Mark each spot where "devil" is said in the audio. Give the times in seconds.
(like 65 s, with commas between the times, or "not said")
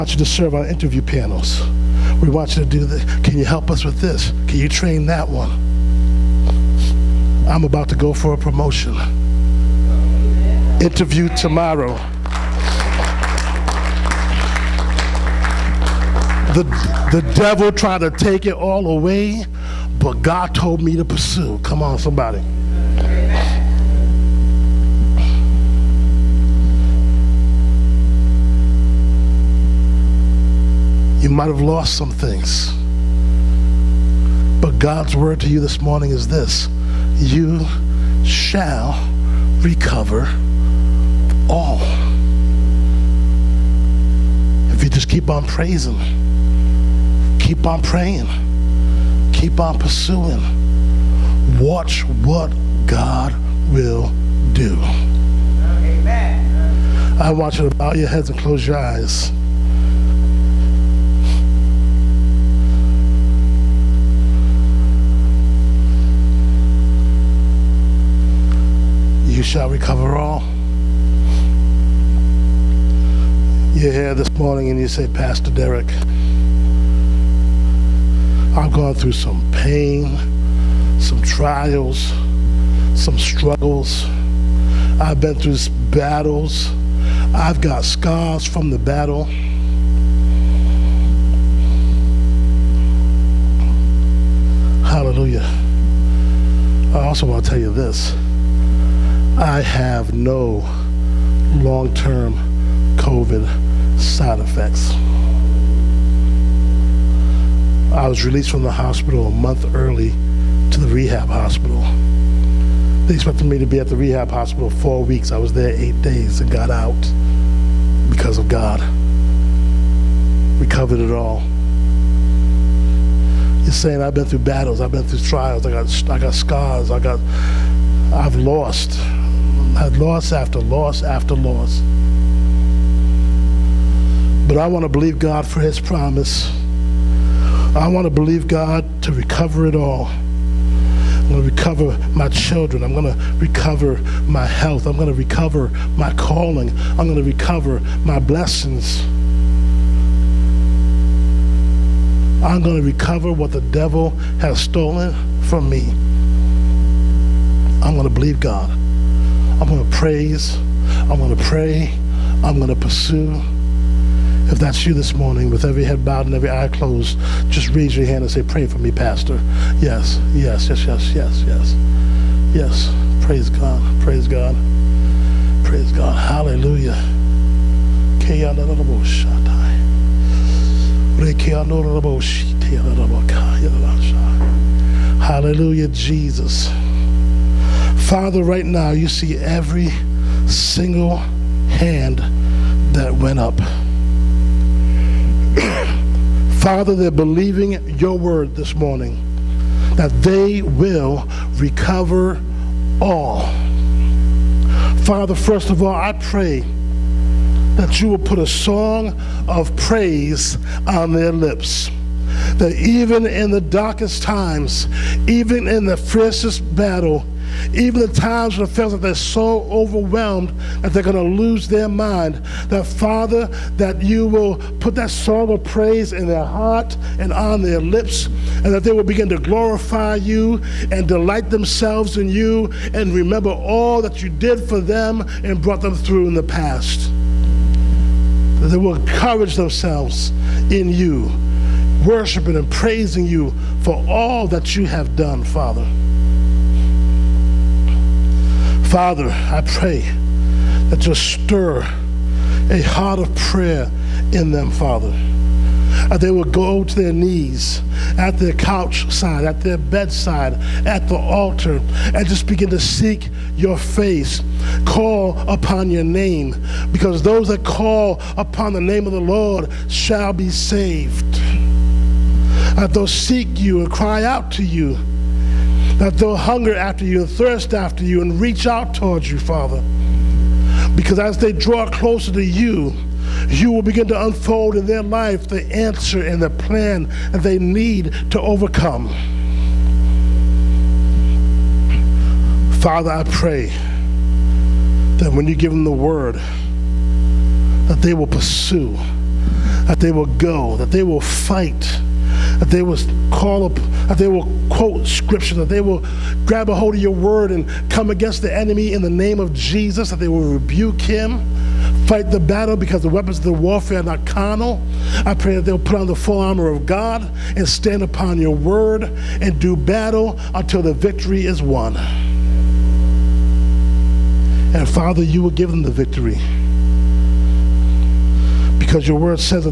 17 s, 153 s.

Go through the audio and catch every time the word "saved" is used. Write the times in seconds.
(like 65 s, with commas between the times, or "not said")
270 s.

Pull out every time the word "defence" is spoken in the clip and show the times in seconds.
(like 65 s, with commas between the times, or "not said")
not said.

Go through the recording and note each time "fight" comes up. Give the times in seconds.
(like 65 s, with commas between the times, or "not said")
301 s, 312 s.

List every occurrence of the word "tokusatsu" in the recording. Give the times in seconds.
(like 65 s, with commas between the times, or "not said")
not said.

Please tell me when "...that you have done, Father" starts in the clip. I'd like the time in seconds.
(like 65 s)
244 s.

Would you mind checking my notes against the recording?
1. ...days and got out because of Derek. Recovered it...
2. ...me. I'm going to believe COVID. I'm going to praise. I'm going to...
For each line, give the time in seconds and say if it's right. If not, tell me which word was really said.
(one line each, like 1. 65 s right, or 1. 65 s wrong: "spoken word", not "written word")
1. 116 s wrong: "God", not "Derek"
2. 155 s wrong: "God", not "COVID".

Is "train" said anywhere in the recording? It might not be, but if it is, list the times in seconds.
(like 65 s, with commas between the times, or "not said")
4 s.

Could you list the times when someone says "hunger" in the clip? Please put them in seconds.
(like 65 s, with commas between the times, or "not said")
276 s.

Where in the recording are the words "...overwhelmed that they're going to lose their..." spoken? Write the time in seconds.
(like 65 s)
219 s.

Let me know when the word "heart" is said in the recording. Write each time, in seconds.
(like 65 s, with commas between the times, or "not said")
226 s, 252 s.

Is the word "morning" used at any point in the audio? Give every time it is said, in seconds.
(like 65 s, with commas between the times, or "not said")
35 s, 74 s, 165 s, 198 s.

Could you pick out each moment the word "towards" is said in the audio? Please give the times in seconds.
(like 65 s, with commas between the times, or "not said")
278 s.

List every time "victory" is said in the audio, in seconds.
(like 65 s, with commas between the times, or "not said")
320 s, 325 s.